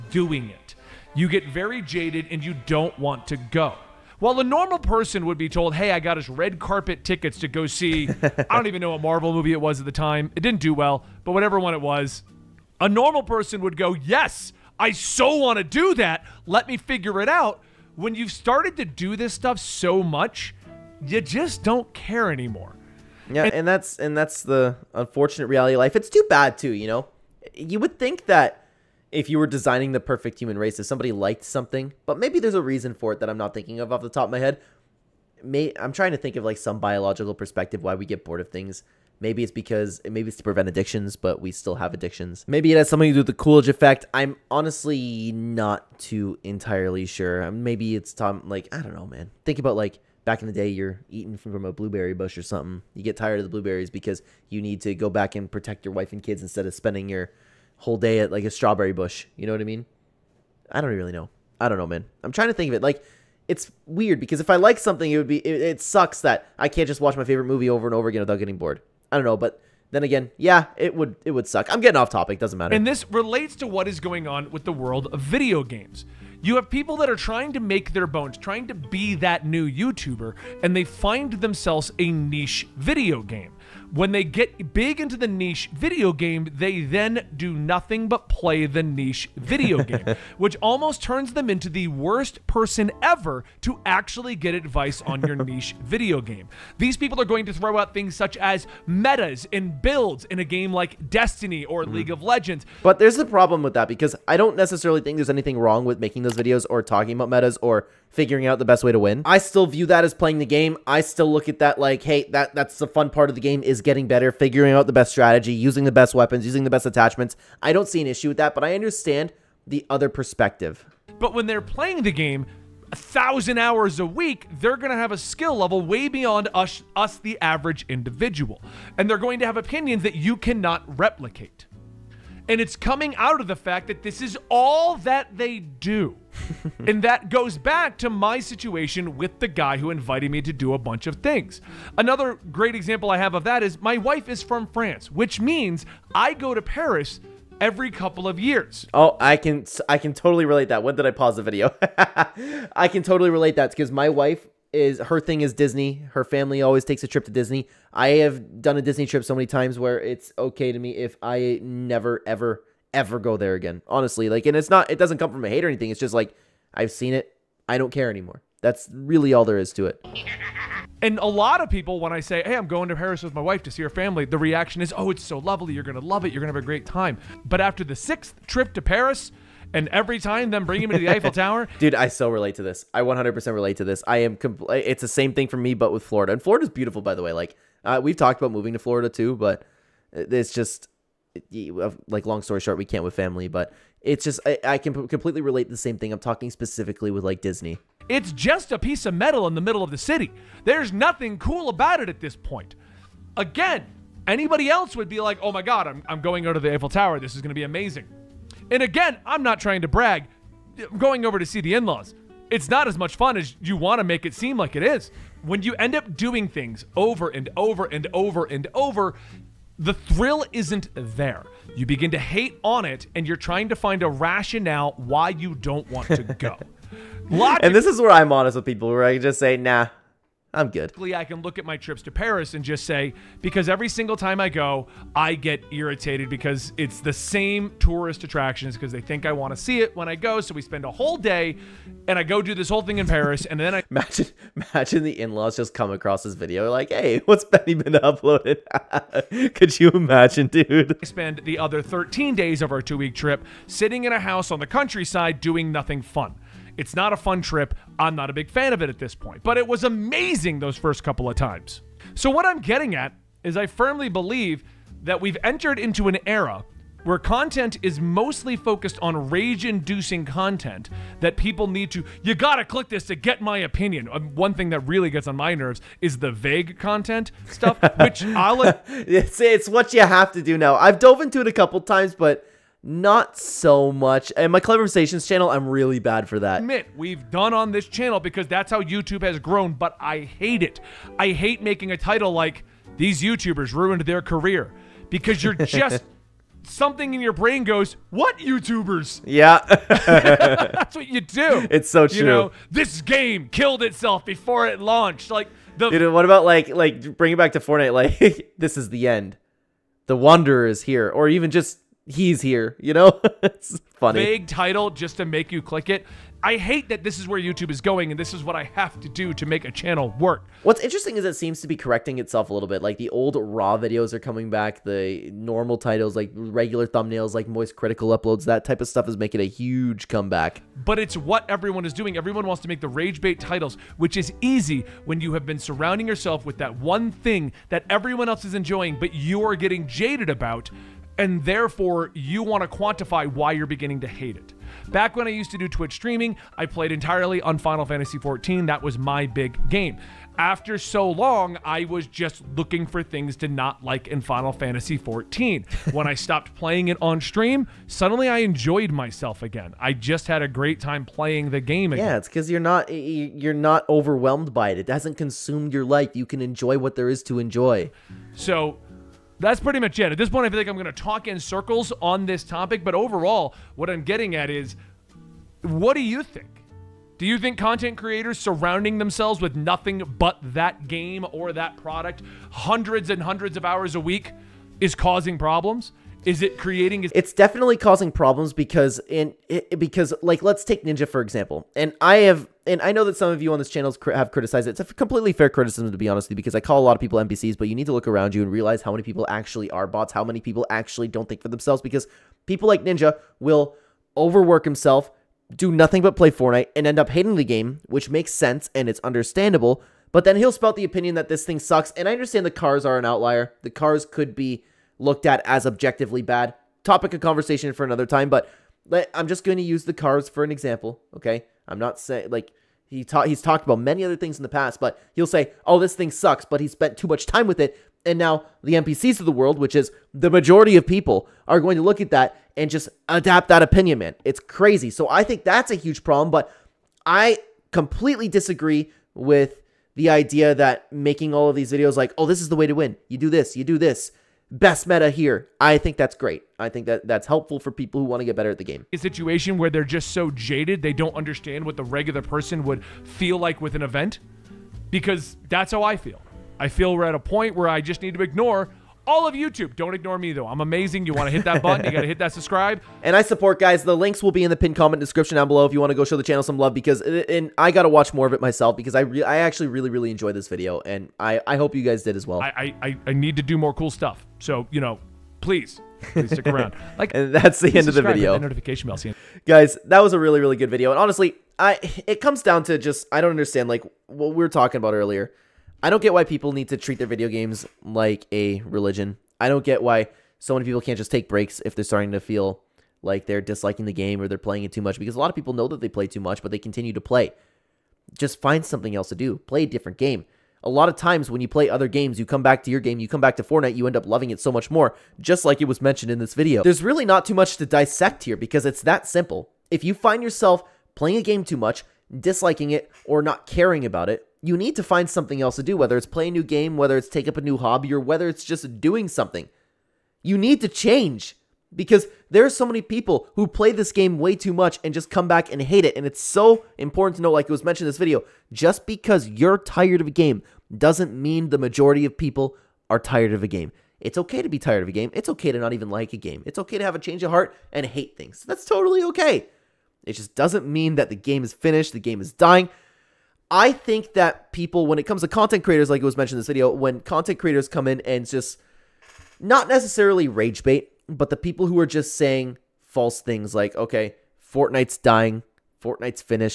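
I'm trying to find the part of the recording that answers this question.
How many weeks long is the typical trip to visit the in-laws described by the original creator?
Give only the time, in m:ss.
4:12.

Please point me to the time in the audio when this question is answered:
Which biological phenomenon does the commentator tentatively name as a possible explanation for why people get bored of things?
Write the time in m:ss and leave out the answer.
0:43.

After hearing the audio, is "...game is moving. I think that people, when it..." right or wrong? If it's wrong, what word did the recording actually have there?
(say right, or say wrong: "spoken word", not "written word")
wrong: "dying", not "moving".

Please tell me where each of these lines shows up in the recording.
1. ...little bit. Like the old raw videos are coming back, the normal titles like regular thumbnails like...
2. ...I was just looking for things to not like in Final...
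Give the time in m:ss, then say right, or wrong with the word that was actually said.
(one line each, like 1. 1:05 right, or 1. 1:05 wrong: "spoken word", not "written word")
1. 5:22 right
2. 5:51 right.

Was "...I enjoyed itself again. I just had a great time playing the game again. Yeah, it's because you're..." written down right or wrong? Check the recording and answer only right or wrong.
wrong.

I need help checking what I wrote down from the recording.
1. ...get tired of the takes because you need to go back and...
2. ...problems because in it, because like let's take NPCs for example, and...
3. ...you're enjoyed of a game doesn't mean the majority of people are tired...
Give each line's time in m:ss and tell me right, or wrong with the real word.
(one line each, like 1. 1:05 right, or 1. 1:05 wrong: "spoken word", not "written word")
1. 0:53 wrong: "blueberries", not "takes"
2. 6:28 wrong: "Ninja", not "NPCs"
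3. 8:49 wrong: "tired", not "enjoyed".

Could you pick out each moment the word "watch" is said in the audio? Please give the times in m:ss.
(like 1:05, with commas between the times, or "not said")
1:06, 7:47.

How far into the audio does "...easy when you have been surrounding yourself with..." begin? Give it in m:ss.
5:34.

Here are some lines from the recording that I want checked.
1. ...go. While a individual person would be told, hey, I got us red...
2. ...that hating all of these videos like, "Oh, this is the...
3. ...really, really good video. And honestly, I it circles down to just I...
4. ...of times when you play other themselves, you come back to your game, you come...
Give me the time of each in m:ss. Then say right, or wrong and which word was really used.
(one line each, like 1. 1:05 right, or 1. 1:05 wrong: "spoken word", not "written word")
1. 0:03 wrong: "normal", not "individual"
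2. 7:20 wrong: "making", not "hating"
3. 8:00 wrong: "comes", not "circles"
4. 8:20 wrong: "games", not "themselves".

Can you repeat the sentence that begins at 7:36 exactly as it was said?
I feel we're at a point where I just need to ignore all of YouTube.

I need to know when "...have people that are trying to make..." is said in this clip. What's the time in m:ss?
1:16.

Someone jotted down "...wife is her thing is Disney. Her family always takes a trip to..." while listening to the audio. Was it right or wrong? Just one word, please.
right.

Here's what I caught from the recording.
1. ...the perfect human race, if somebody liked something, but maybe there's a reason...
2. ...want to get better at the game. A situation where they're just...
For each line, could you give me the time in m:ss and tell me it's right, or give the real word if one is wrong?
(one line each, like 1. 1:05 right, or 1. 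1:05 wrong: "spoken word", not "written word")
1. 0:29 right
2. 7:28 right.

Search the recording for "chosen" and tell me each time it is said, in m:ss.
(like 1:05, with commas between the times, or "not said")
not said.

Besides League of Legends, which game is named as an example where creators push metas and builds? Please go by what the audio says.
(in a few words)
Destiny.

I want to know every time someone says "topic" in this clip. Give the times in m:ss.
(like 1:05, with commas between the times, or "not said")
1:12, 6:12, 6:56.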